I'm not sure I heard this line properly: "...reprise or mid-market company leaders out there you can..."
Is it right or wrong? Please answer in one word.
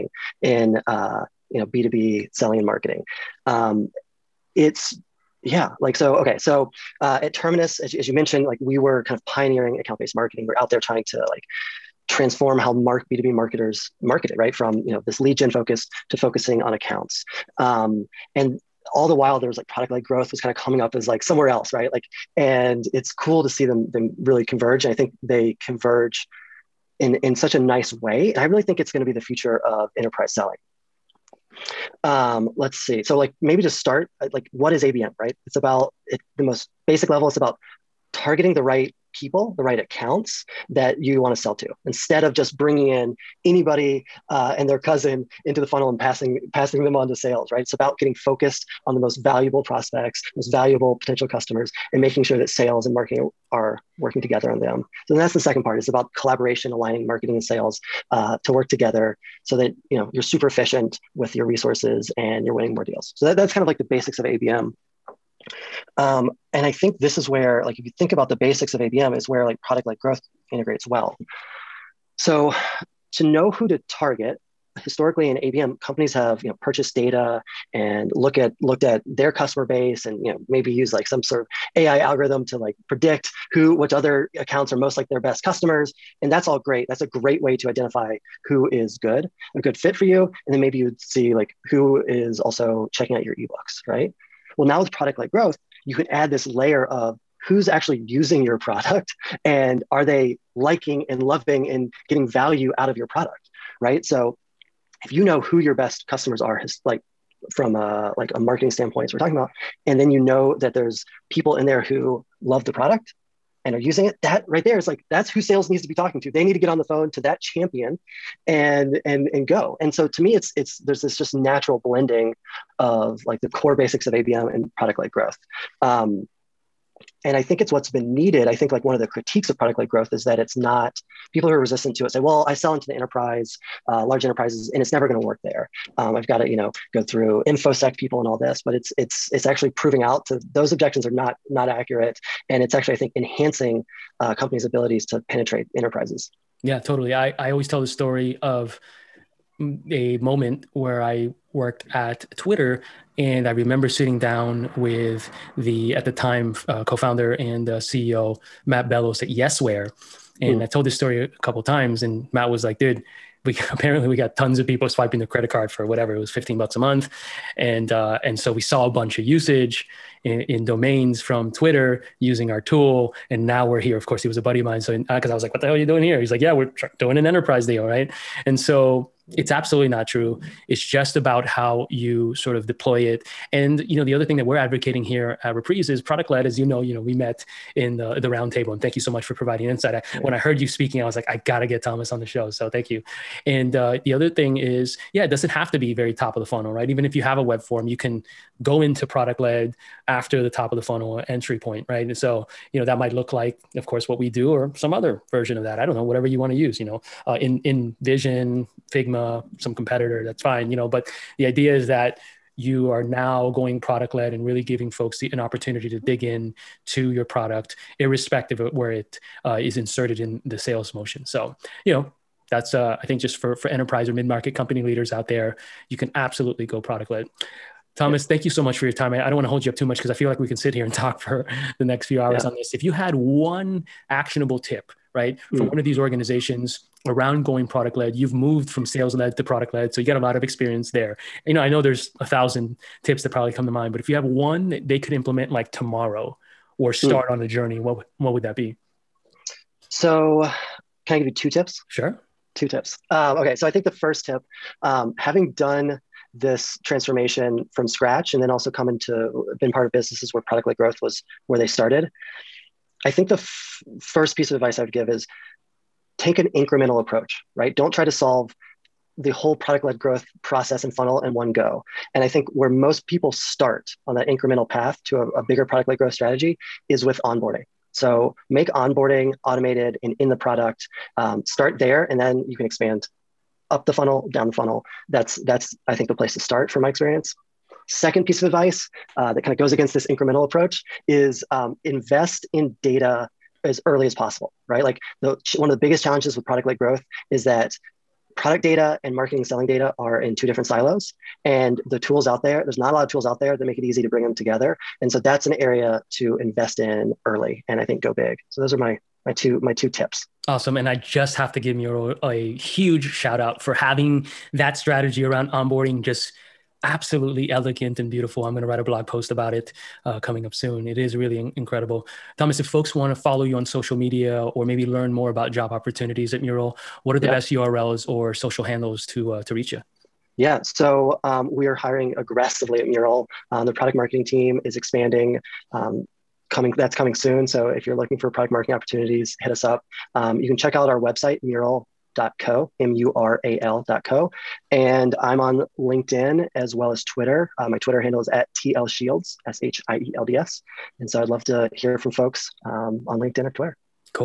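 wrong.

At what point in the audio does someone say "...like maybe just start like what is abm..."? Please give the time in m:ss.
0:33.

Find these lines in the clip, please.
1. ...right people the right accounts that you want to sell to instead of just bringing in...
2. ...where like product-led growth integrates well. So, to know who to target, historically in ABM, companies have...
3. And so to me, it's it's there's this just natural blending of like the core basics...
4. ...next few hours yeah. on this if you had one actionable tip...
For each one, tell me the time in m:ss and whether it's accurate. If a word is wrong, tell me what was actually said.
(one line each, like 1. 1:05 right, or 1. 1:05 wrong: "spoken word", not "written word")
1. 0:38 right
2. 1:09 right
3. 1:59 right
4. 3:51 right.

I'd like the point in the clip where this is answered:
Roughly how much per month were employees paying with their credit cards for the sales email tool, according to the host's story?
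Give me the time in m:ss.
2:46.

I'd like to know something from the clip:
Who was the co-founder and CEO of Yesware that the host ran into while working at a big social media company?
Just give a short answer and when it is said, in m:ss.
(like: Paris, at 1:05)
Matt Bellows, at 2:38.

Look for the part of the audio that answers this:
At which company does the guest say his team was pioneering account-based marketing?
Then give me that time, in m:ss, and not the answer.
0:07.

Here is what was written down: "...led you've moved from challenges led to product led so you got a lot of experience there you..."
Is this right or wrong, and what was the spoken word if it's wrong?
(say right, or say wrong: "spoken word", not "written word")
wrong: "sales", not "challenges".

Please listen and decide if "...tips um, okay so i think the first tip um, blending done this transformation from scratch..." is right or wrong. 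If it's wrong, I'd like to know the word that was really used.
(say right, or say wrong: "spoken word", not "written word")
wrong: "having", not "blending".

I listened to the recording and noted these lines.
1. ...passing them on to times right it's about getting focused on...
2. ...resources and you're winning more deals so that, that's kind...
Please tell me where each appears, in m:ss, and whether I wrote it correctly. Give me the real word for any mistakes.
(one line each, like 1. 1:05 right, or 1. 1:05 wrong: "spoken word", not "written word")
1. 0:46 wrong: "sales", not "times"
2. 1:01 right.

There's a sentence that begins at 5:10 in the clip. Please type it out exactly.
And I just have to give you a huge shout out for having that strategy around onboarding just absolutely elegant and beautiful.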